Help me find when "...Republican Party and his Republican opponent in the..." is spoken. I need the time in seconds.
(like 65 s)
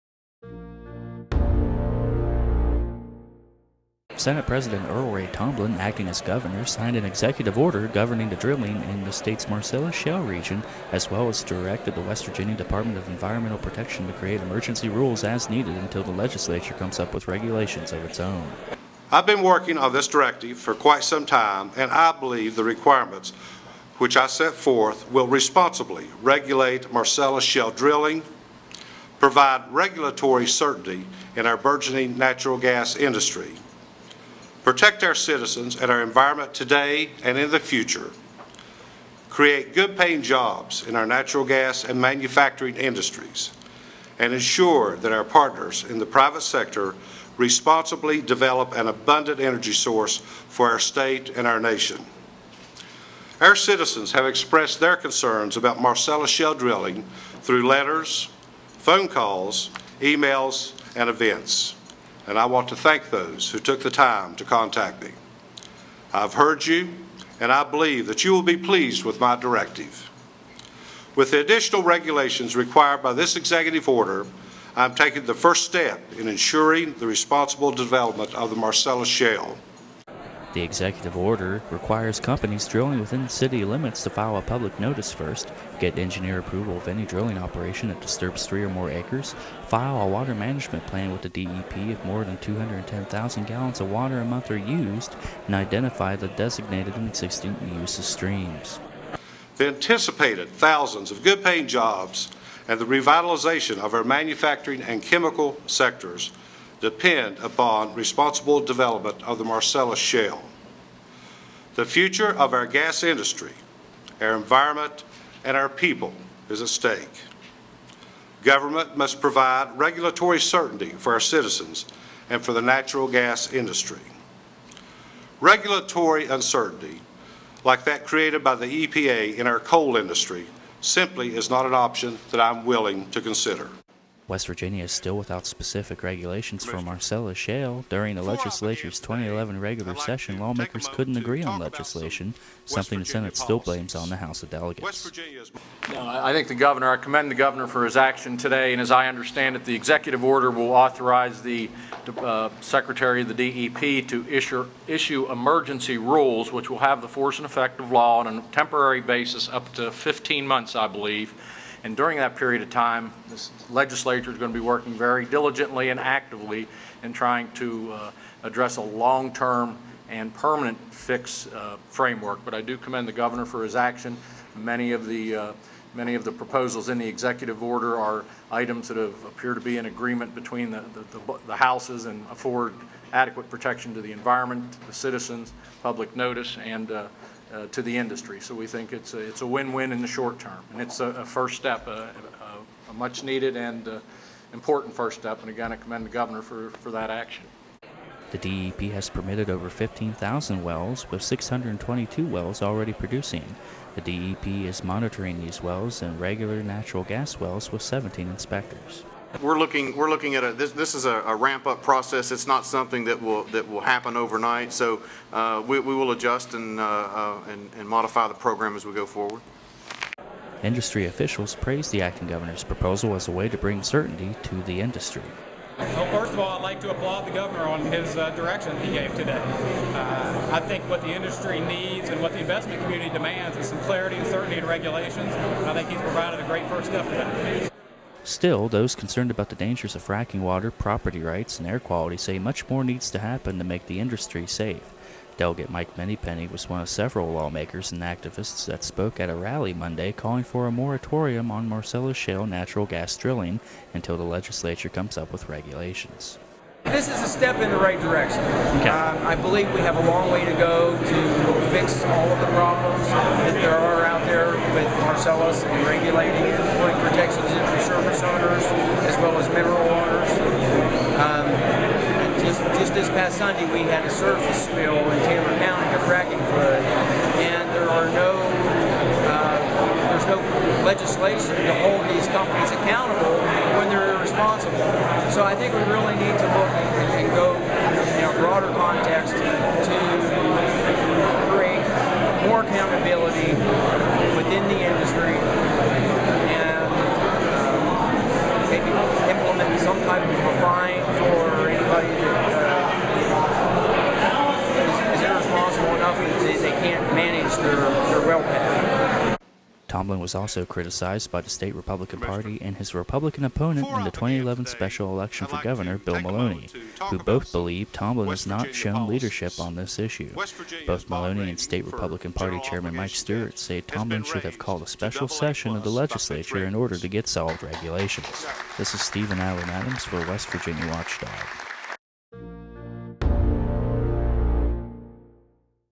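311 s.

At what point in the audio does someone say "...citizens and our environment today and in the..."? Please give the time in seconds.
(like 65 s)
35 s.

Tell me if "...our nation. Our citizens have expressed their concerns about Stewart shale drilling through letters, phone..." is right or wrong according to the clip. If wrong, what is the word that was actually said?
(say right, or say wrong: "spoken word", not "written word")
wrong: "Marcellus", not "Stewart".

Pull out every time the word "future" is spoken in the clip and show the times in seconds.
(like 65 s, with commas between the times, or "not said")
37 s, 111 s.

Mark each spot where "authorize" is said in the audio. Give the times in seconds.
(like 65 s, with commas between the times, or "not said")
150 s.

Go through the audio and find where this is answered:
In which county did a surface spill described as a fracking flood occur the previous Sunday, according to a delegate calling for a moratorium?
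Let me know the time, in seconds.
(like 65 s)
275 s.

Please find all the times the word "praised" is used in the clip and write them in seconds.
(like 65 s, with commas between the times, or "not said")
221 s.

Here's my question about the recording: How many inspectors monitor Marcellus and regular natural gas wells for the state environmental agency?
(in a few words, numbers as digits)
17.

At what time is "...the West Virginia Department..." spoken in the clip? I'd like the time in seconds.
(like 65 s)
11 s.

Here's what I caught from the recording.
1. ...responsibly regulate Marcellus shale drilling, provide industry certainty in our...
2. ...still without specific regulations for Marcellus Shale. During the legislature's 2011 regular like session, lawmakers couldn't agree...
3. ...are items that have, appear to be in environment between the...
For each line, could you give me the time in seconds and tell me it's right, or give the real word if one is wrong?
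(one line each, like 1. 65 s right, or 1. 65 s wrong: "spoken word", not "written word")
1. 25 s wrong: "regulatory", not "industry"
2. 134 s right
3. 177 s wrong: "agreement", not "environment".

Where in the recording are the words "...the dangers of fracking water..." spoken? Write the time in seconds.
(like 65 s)
239 s.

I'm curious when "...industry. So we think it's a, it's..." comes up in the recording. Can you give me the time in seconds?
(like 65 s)
187 s.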